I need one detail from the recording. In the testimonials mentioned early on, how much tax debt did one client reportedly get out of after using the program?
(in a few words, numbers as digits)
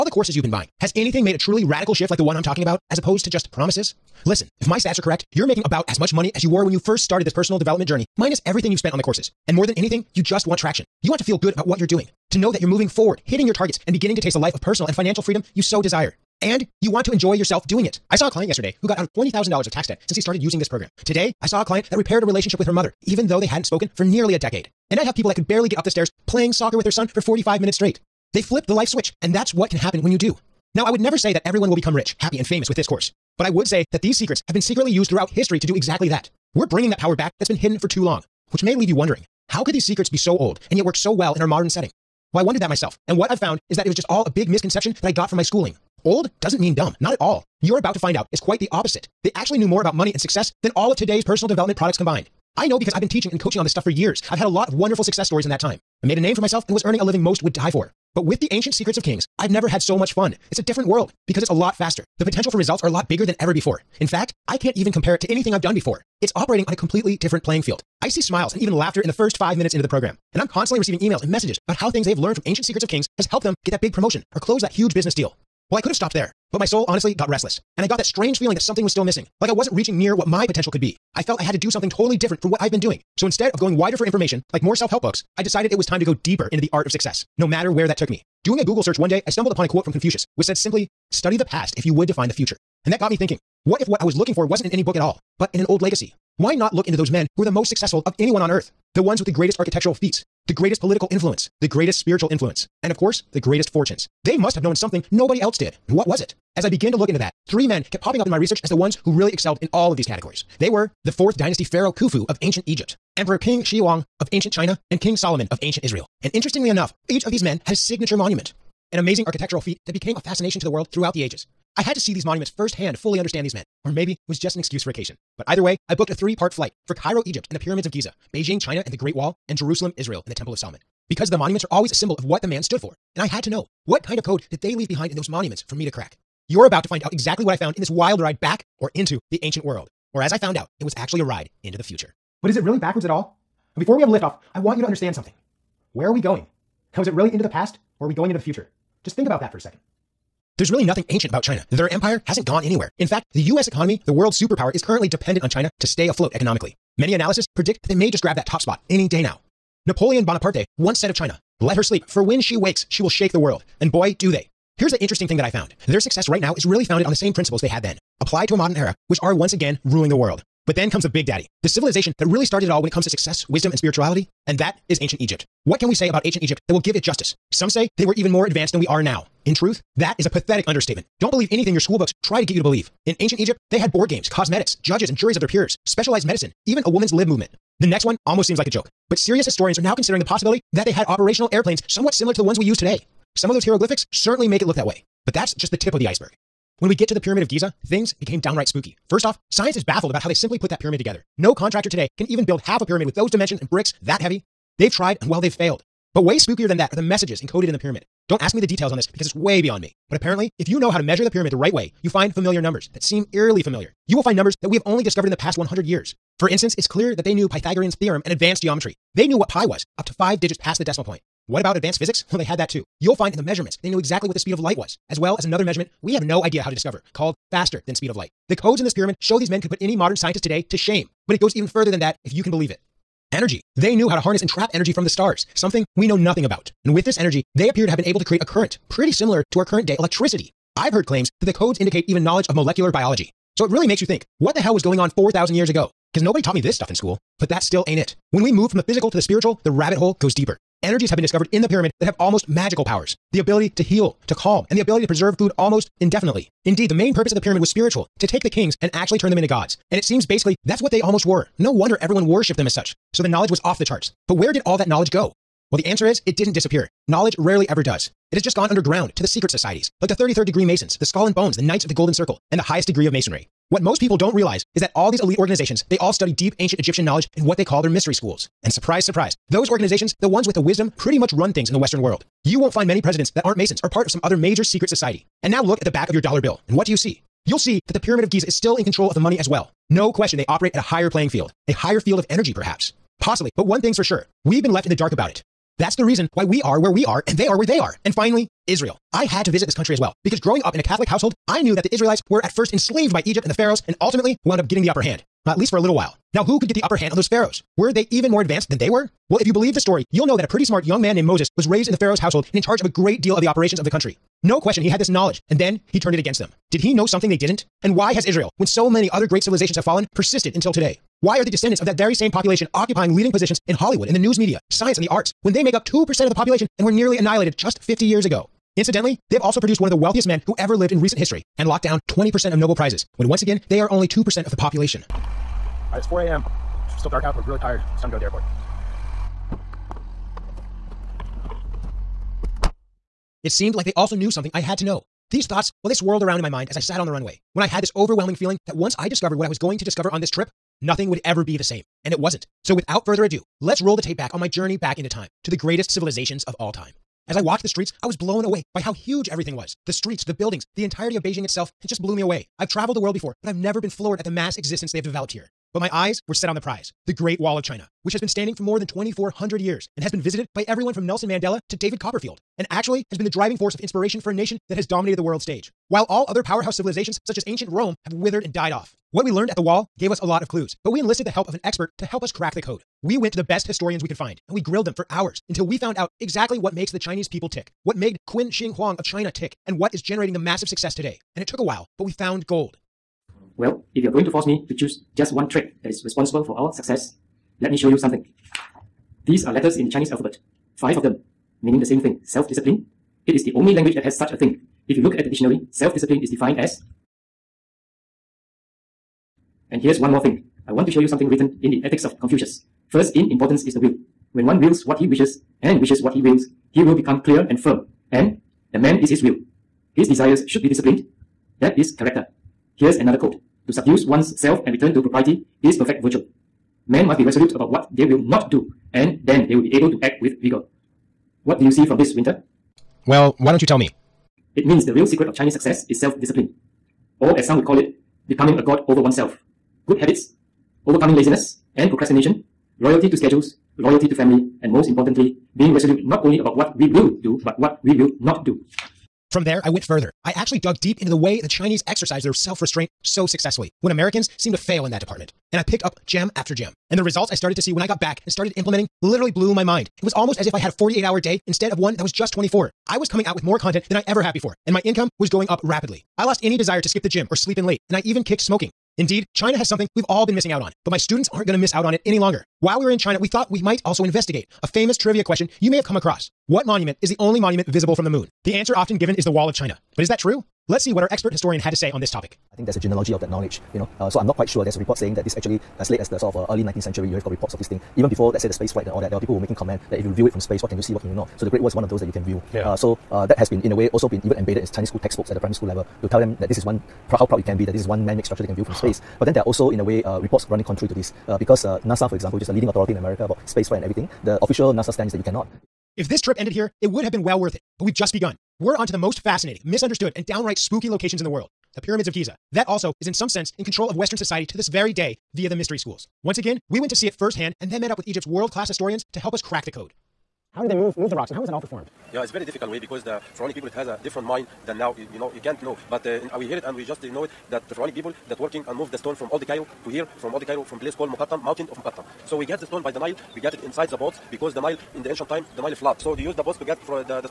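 $20,000.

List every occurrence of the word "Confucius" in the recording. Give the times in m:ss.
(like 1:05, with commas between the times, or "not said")
1:29, 6:52.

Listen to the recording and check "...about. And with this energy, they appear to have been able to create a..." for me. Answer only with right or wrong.
right.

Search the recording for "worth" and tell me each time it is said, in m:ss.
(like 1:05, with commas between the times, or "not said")
8:27.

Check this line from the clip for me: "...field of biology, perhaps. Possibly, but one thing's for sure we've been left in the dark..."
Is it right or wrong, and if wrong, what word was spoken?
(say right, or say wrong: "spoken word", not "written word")
wrong: "energy", not "biology".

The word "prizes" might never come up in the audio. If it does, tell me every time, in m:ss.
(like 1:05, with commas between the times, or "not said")
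5:32, 6:06.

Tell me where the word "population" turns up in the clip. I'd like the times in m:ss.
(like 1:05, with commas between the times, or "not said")
5:22, 5:26, 5:34.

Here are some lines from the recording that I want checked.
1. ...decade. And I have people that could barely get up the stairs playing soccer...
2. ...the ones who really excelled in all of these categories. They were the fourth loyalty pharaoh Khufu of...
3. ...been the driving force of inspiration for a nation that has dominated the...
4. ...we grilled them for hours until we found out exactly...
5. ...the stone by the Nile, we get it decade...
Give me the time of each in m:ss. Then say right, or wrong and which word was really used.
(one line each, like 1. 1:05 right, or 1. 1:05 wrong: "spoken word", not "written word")
1. 0:24 right
2. 1:48 wrong: "dynasty", not "loyalty"
3. 6:13 right
4. 6:24 right
5. 8:52 wrong: "inside", not "decade".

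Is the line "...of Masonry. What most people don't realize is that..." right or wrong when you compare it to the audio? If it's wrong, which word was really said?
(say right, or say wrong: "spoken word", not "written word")
right.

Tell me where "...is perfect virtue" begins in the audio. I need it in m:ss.
7:05.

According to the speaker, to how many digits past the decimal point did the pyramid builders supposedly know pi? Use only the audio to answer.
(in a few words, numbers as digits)
5.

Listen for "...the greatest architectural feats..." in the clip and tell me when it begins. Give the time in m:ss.
1:39.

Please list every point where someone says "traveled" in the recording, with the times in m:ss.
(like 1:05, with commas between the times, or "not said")
6:02.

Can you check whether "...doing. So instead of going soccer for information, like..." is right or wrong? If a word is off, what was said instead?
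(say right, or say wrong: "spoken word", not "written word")
wrong: "wider", not "soccer".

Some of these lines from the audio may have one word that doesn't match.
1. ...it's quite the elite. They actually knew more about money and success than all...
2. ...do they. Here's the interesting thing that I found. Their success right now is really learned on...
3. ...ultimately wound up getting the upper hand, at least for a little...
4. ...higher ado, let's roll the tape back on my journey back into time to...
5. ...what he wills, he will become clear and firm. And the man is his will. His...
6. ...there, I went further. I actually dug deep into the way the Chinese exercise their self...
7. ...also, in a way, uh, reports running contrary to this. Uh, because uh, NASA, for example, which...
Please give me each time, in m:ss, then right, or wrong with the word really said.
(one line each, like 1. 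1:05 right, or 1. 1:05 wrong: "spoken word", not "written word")
1. 0:48 wrong: "opposite", not "elite"
2. 2:44 wrong: "founded", not "learned"
3. 5:03 right
4. 5:53 wrong: "further", not "higher"
5. 6:56 right
6. 7:29 right
7. 8:19 right.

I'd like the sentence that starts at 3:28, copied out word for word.
Don't ask me the details on this because it's way beyond me.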